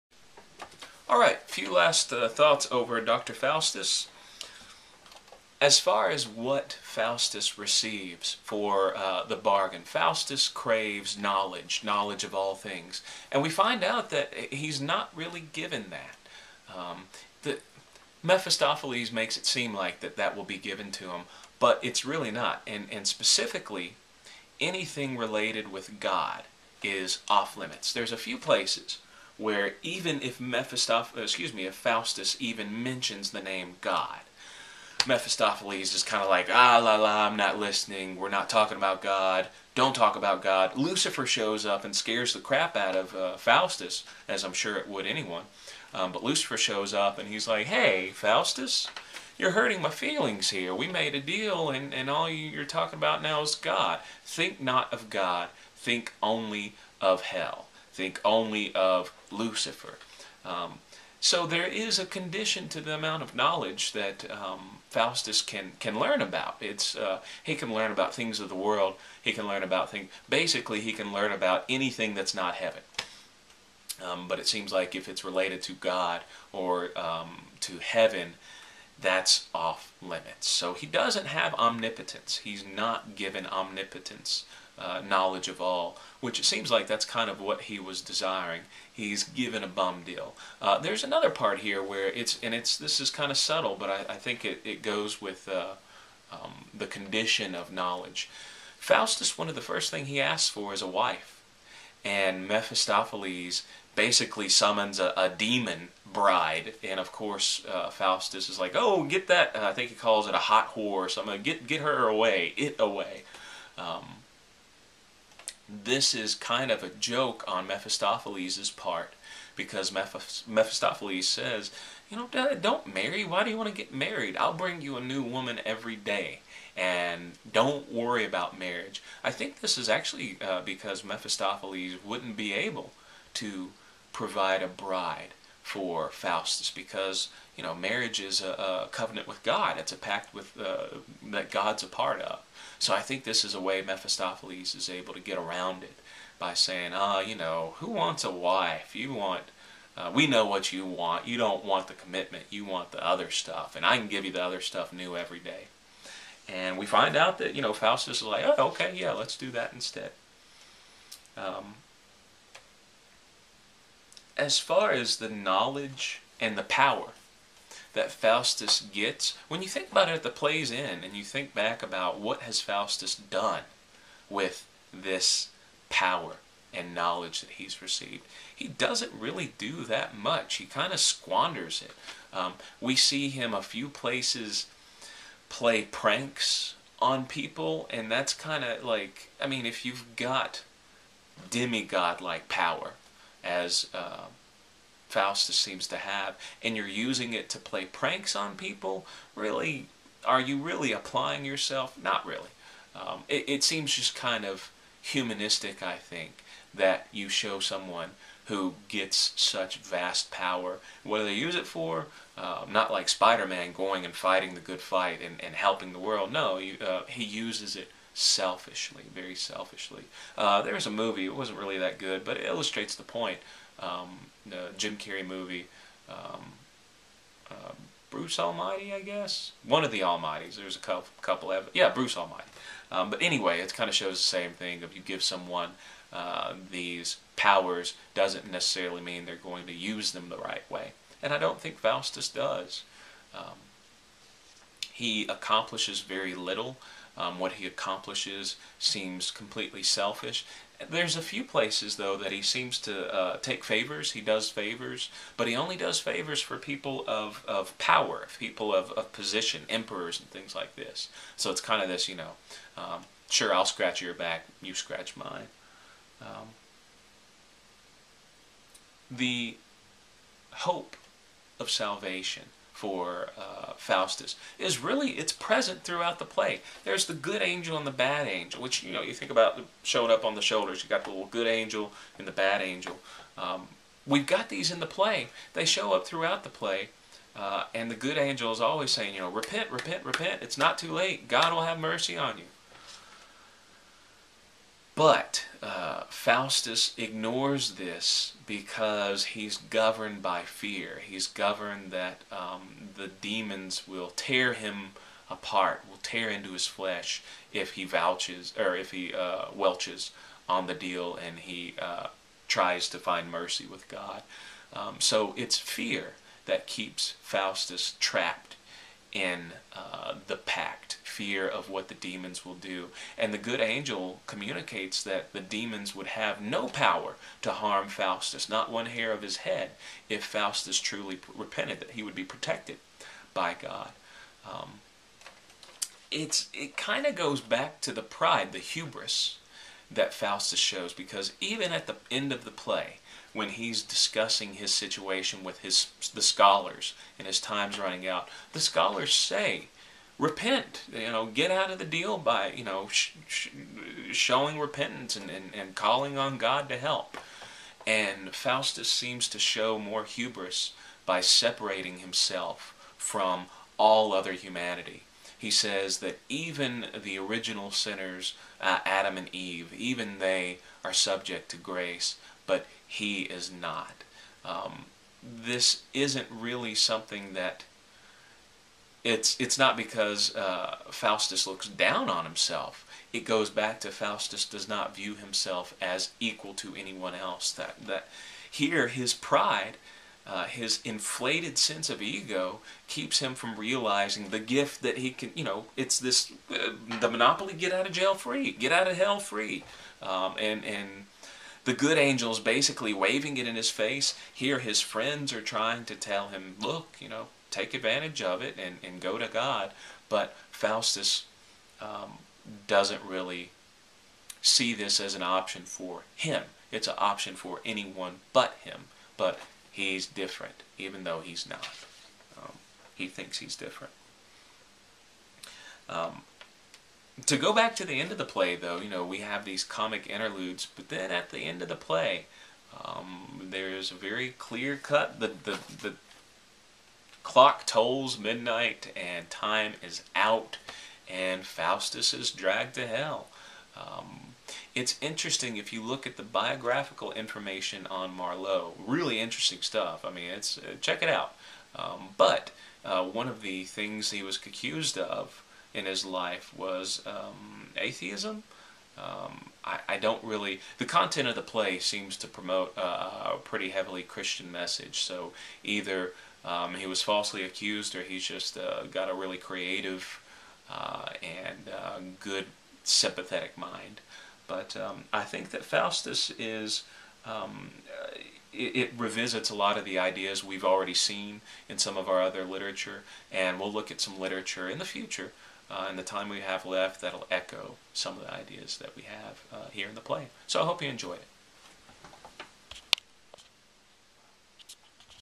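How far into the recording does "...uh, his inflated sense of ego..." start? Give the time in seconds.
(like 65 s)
390 s.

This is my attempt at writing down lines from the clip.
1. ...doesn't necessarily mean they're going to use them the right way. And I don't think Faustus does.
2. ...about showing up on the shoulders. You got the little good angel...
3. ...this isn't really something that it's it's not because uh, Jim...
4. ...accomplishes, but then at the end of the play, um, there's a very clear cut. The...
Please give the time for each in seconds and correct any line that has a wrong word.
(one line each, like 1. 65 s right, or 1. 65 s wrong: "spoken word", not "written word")
1. 238 s right
2. 279 s right
3. 375 s wrong: "Faustus", not "Jim"
4. 430 s wrong: "interludes", not "accomplishes".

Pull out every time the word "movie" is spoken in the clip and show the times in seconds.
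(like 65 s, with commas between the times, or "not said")
220 s, 225 s.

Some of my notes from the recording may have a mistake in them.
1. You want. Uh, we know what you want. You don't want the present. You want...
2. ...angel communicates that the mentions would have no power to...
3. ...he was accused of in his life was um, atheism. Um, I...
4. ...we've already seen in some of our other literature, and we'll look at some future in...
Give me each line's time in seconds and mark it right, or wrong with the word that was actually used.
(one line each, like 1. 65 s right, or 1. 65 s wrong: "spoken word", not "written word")
1. 148 s wrong: "commitment", not "present"
2. 323 s wrong: "demons", not "mentions"
3. 454 s right
4. 480 s wrong: "literature", not "future".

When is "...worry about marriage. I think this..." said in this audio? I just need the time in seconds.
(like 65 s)
127 s.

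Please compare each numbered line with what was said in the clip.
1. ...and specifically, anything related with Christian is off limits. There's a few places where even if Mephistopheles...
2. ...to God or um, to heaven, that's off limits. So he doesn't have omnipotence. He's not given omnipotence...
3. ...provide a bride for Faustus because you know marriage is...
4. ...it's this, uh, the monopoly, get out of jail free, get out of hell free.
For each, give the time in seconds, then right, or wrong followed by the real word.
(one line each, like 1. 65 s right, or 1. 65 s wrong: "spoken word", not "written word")
1. 22 s wrong: "God", not "Christian"
2. 75 s right
3. 134 s right
4. 395 s right.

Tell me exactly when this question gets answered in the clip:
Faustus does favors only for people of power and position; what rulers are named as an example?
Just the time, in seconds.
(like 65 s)
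259 s.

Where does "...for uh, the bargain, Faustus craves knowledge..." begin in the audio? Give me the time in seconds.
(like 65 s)
8 s.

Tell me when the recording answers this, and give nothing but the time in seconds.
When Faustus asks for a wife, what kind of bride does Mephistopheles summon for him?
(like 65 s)
105 s.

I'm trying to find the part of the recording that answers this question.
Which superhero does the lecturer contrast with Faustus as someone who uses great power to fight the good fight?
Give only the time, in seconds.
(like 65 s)
213 s.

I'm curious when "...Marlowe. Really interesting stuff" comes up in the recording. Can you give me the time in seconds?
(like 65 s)
448 s.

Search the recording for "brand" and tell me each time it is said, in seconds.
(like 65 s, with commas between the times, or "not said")
not said.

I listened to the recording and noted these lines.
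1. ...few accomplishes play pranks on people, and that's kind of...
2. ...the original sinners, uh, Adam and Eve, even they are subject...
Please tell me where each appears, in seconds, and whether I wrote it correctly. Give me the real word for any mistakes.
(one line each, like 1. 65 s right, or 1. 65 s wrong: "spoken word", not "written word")
1. 183 s wrong: "places", not "accomplishes"
2. 367 s right.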